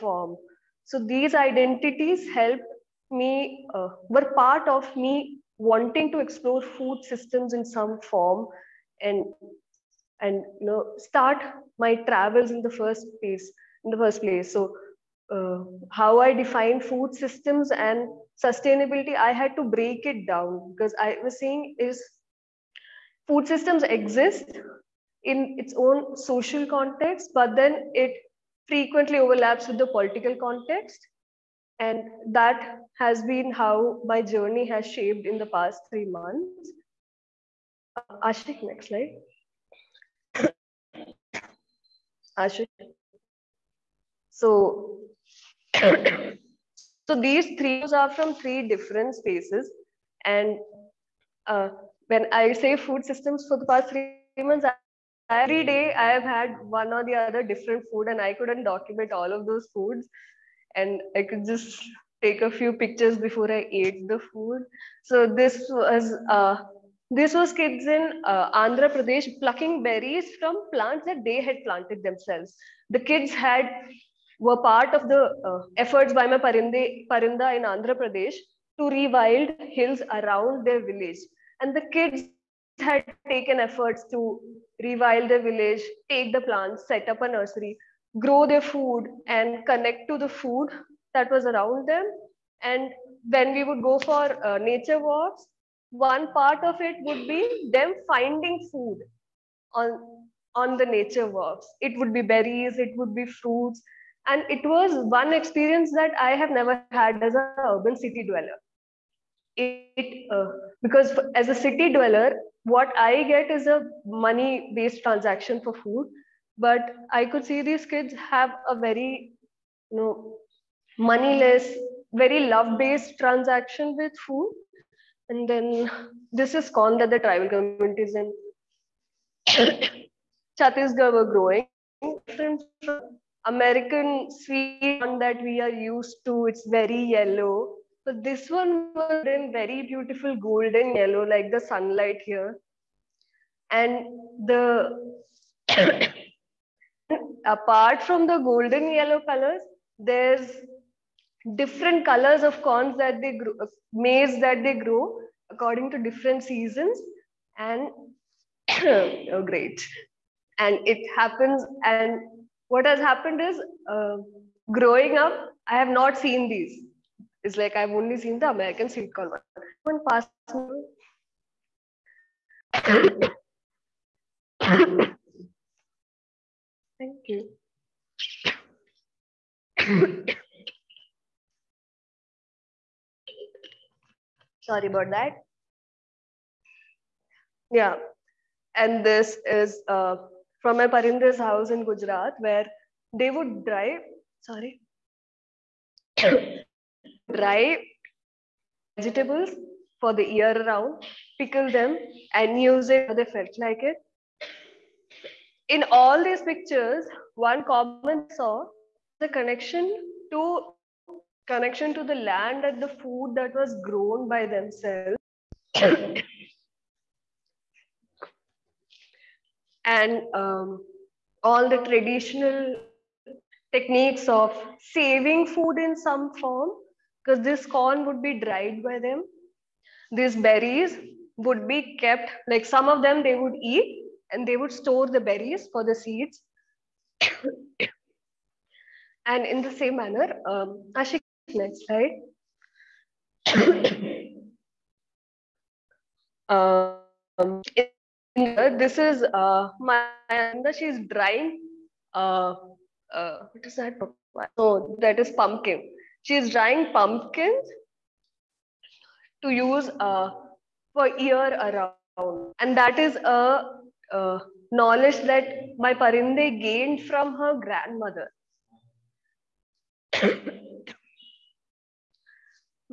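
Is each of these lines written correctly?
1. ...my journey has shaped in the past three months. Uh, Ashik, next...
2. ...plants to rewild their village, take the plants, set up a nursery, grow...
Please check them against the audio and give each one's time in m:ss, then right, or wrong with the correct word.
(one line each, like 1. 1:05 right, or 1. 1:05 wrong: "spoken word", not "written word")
1. 0:34 right
2. 1:23 wrong: "efforts", not "plants".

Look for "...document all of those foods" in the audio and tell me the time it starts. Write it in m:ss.
0:58.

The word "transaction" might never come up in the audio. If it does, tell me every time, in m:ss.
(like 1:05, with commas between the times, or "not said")
1:55, 2:03.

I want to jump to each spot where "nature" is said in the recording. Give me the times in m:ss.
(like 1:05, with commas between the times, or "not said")
1:34, 1:40.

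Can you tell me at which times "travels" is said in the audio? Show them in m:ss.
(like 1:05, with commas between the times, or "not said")
0:12.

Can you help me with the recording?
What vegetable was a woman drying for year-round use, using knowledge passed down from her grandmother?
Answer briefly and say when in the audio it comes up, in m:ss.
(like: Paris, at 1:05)
Pumpkin, at 4:16.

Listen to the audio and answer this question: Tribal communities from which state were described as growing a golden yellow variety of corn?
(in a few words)
Chhattisgarh.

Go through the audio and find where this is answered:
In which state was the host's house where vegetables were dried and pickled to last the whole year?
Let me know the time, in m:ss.
3:11.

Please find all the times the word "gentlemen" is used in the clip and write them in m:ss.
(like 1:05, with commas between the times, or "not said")
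not said.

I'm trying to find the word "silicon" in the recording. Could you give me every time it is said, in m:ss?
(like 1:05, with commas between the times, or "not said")
2:48.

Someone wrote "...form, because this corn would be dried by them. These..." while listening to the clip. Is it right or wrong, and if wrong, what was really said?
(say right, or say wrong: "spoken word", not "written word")
right.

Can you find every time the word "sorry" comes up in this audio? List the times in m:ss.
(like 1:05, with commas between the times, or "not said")
3:04, 3:14.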